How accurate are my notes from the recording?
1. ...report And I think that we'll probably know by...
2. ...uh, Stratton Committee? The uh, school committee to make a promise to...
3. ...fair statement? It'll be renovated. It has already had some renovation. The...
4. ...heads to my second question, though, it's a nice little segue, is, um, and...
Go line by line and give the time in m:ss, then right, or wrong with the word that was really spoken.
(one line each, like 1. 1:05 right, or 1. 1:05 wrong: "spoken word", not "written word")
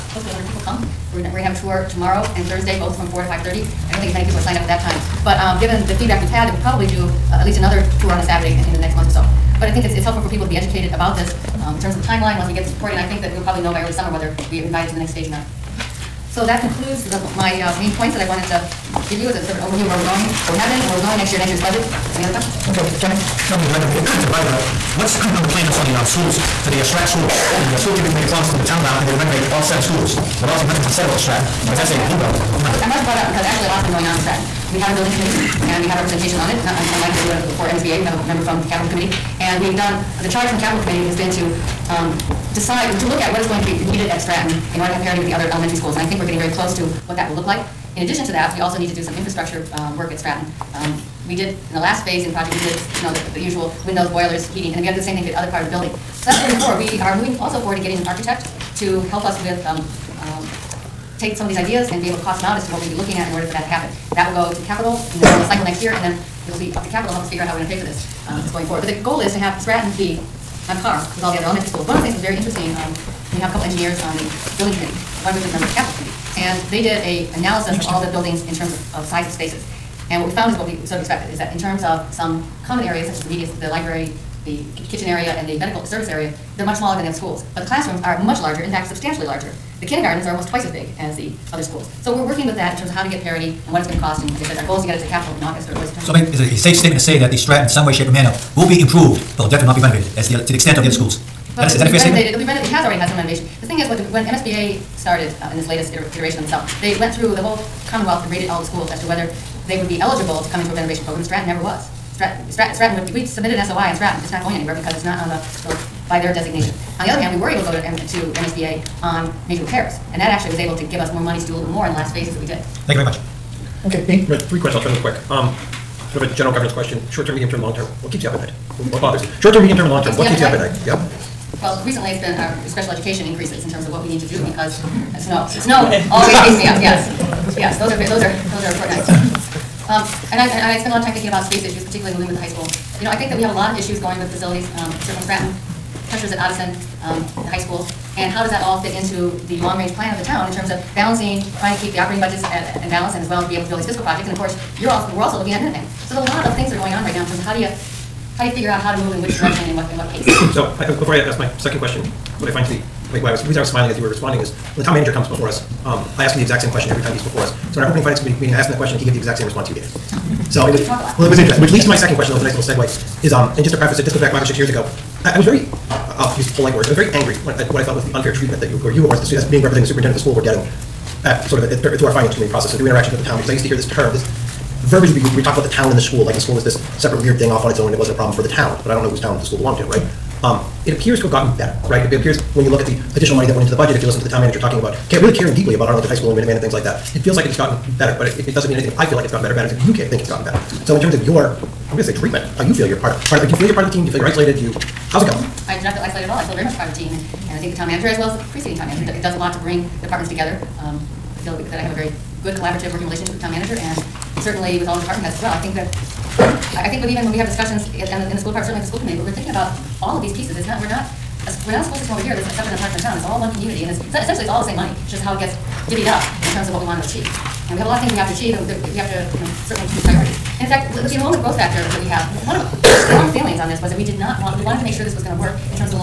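1. 0:12 right
2. 0:26 wrong: "School", not "Committee"
3. 1:41 right
4. 2:51 wrong: "leads", not "heads".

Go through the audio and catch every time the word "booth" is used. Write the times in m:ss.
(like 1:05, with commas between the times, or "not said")
not said.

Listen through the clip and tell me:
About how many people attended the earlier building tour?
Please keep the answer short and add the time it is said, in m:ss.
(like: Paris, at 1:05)
100, at 0:00.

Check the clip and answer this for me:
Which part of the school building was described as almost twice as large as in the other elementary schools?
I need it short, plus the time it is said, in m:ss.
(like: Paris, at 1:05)
kindergartens, at 1:29.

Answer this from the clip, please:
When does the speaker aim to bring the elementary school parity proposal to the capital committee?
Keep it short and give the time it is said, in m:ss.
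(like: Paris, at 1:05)
August or early September, at 1:35.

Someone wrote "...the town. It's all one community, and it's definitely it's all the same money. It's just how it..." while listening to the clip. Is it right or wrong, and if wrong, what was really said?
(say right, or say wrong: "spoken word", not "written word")
wrong: "essentially", not "definitely".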